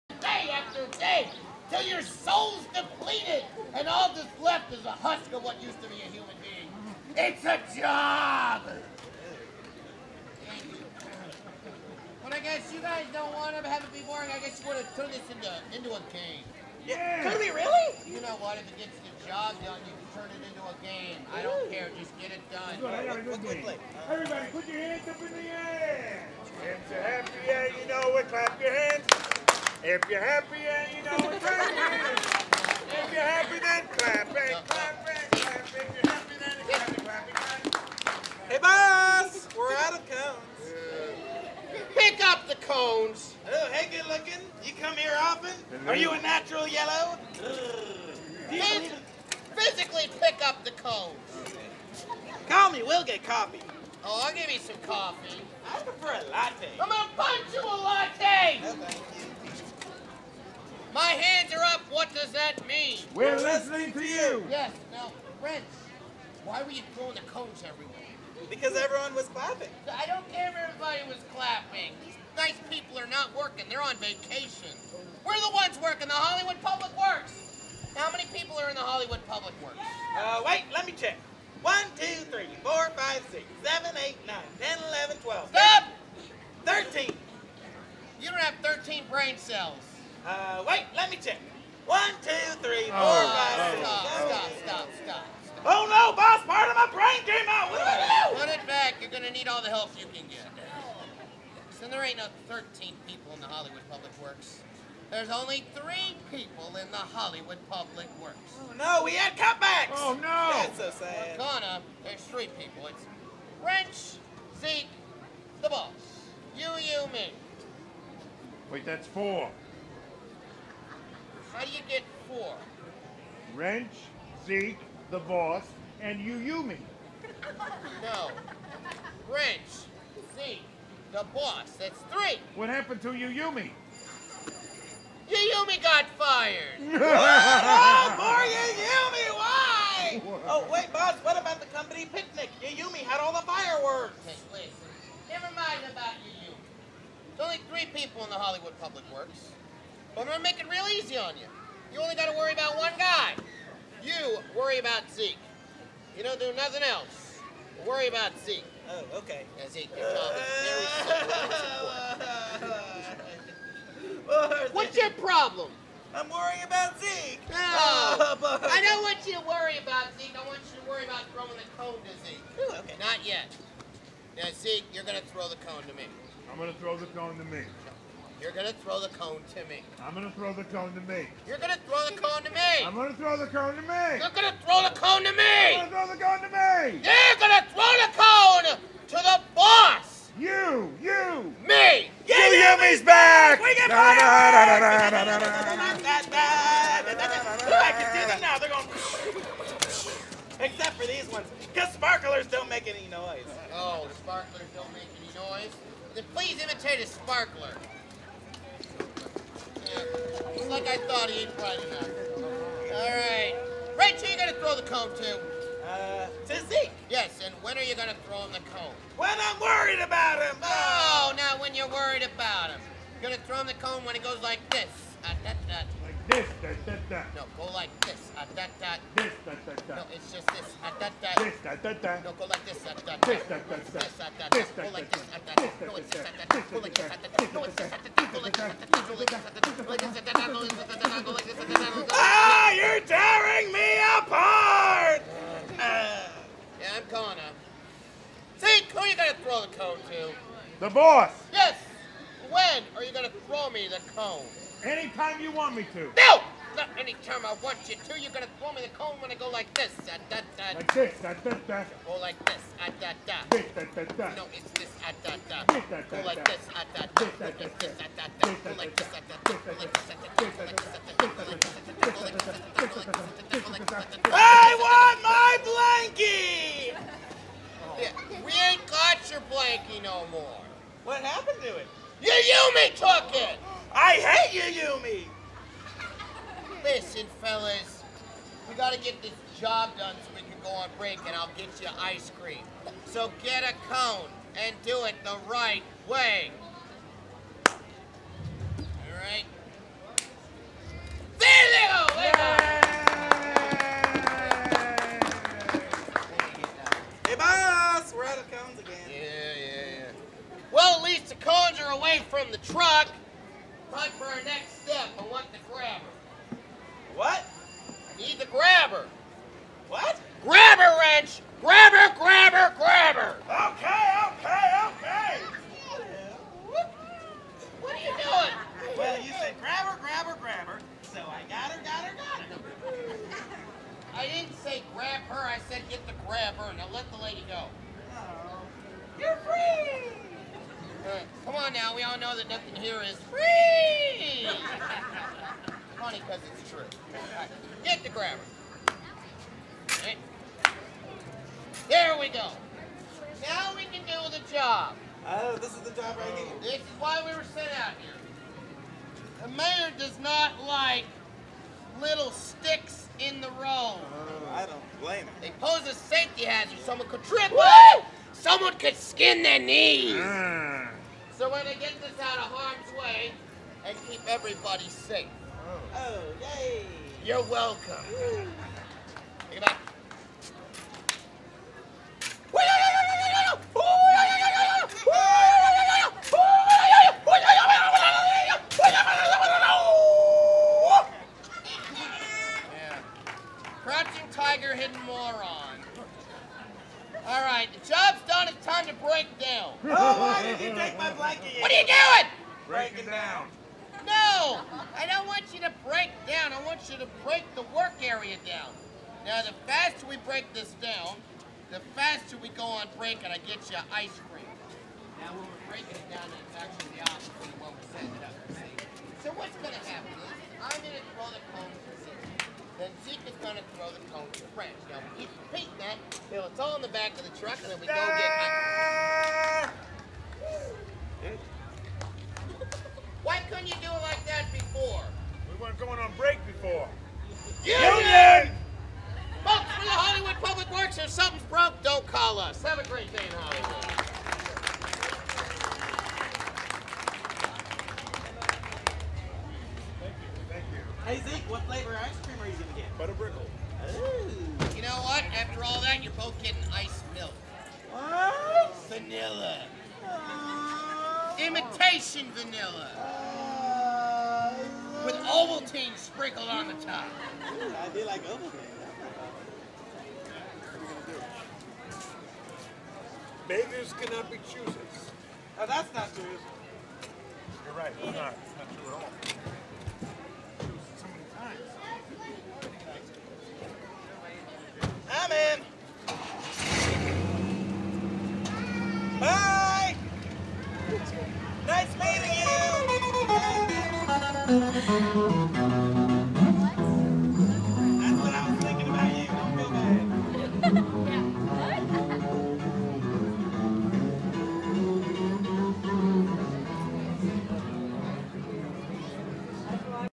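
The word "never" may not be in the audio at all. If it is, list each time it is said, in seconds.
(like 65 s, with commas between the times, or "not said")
145 s.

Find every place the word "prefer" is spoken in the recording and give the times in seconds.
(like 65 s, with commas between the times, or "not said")
55 s.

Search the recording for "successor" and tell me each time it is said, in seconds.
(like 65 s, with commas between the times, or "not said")
not said.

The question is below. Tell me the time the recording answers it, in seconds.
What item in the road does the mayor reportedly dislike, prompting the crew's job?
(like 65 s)
362 s.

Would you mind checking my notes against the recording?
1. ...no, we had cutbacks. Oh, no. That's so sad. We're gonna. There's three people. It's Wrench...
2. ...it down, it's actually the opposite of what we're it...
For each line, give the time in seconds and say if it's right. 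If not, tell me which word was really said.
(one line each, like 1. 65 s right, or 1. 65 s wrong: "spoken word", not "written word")
1. 108 s right
2. 416 s right.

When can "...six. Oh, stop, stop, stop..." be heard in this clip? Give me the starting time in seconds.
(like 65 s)
93 s.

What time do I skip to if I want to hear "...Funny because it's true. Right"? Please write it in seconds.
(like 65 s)
345 s.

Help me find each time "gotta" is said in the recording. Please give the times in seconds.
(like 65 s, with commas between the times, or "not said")
288 s.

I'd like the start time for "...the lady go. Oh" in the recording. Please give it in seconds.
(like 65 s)
337 s.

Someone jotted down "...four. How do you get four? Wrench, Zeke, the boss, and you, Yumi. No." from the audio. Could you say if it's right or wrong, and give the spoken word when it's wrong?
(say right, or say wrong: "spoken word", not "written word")
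right.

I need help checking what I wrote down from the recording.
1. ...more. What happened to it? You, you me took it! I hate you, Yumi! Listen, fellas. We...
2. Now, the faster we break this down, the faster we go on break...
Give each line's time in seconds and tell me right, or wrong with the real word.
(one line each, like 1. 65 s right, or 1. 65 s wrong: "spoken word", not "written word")
1. 280 s right
2. 409 s right.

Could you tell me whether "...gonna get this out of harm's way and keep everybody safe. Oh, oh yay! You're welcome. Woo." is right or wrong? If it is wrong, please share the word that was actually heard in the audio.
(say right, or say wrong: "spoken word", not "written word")
right.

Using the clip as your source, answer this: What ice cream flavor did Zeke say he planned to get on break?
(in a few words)
Butterbrickle.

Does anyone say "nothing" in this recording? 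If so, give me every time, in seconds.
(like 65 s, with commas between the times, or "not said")
156 s, 342 s.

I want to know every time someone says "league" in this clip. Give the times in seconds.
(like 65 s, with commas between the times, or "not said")
not said.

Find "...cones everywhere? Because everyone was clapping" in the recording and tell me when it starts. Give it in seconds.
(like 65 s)
67 s.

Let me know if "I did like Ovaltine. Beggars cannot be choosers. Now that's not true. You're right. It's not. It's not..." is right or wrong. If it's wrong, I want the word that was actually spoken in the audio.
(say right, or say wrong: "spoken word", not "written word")
right.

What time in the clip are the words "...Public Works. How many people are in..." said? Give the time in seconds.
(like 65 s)
76 s.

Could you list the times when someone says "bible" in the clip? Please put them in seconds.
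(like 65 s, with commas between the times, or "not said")
not said.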